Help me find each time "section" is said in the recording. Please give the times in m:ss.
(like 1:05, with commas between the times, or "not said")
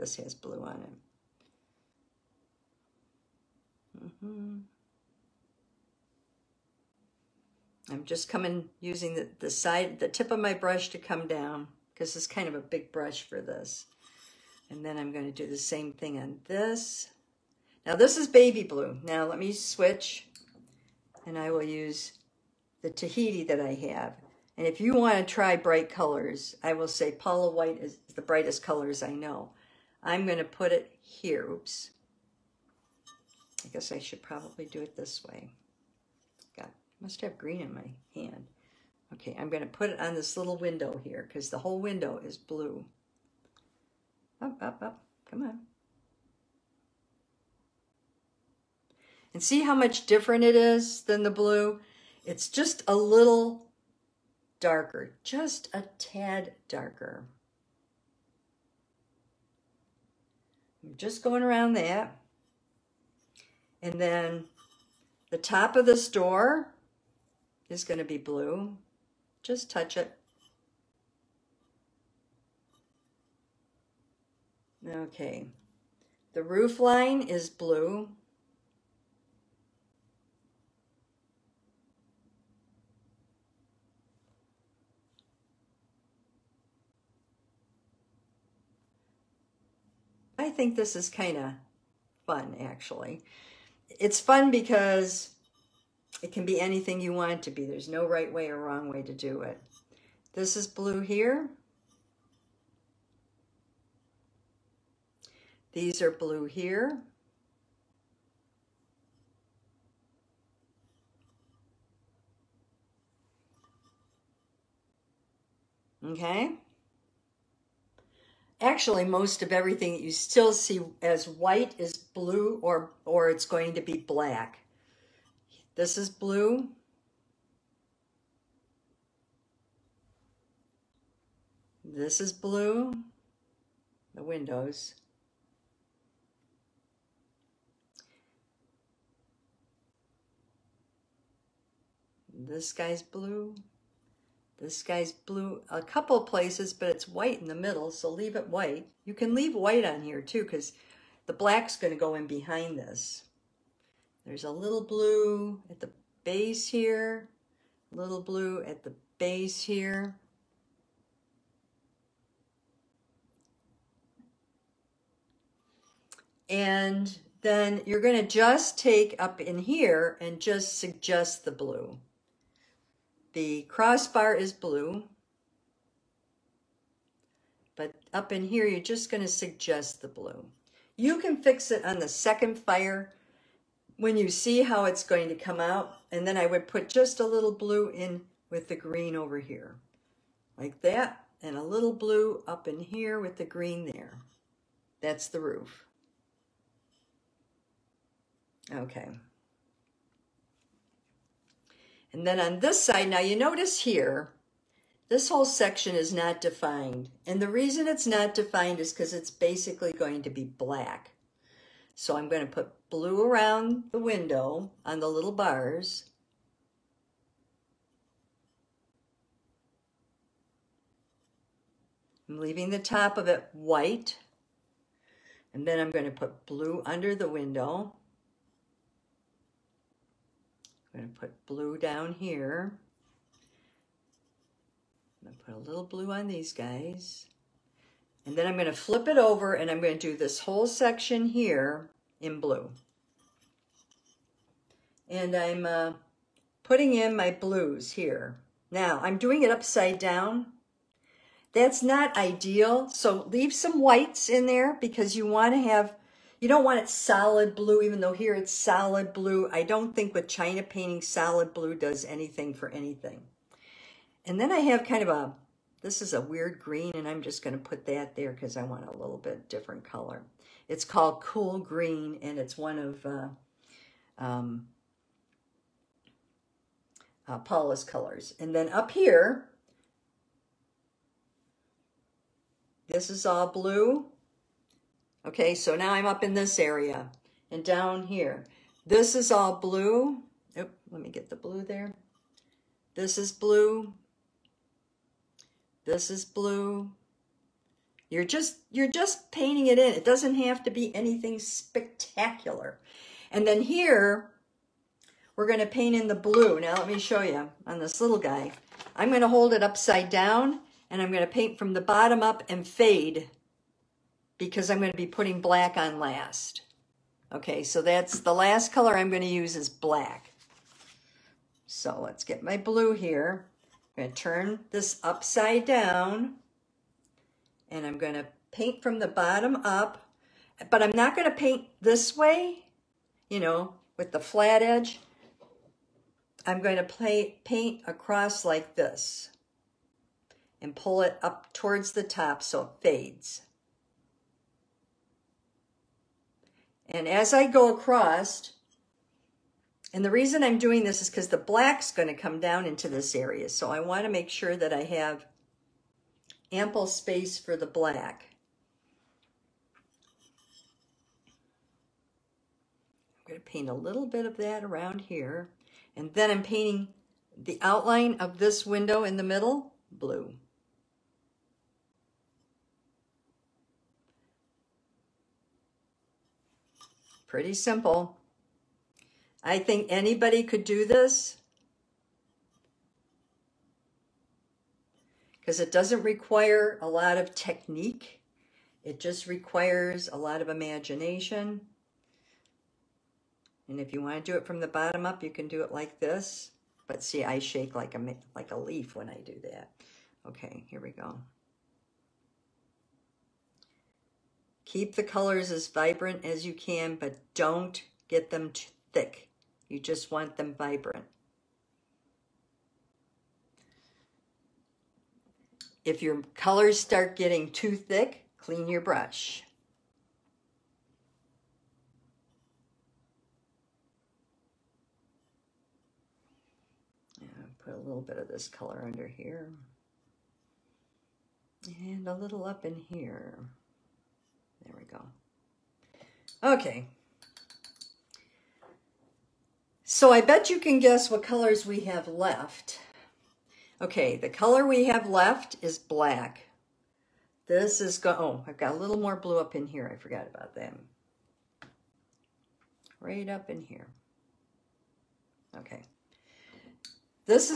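3:25, 4:00.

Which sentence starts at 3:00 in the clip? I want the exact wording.
You can fix it on the second fire when you see how it's going to come out.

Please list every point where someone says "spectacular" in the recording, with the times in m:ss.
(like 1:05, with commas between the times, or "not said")
5:01.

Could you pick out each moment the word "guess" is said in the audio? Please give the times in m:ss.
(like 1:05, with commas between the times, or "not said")
0:33, 7:20.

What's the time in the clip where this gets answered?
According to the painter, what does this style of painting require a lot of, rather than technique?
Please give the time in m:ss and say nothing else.
6:30.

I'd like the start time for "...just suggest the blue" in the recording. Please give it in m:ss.
2:50.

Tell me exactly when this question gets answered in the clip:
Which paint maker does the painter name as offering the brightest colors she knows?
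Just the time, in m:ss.
0:27.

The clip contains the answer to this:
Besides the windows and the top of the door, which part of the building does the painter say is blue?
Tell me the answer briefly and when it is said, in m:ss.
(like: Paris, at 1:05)
roof line, at 1:16.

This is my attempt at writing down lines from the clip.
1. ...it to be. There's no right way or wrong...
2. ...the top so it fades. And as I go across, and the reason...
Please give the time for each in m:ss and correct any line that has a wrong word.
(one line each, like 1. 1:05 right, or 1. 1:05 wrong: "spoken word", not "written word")
1. 1:37 right
2. 5:41 right.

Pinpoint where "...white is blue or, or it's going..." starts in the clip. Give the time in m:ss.
2:01.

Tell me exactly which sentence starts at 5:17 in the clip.
Okay, so that's the last color I'm going to use is black.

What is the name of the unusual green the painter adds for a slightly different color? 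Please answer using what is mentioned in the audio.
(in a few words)
Cool Green.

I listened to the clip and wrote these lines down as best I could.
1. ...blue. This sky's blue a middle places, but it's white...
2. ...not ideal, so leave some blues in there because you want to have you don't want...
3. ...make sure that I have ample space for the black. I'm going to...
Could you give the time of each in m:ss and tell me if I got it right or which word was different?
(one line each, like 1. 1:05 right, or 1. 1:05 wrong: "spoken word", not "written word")
1. 2:23 wrong: "couple", not "middle"
2. 4:11 wrong: "whites", not "blues"
3. 5:54 right.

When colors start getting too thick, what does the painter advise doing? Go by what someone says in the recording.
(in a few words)
clean your brush.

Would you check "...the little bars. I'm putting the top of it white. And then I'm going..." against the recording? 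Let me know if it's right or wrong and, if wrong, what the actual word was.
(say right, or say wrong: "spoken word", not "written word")
wrong: "leaving", not "putting".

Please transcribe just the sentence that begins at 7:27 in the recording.
This is, go oh, I've got a little more blue up in here.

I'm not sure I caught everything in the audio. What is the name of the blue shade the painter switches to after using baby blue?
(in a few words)
Tahiti.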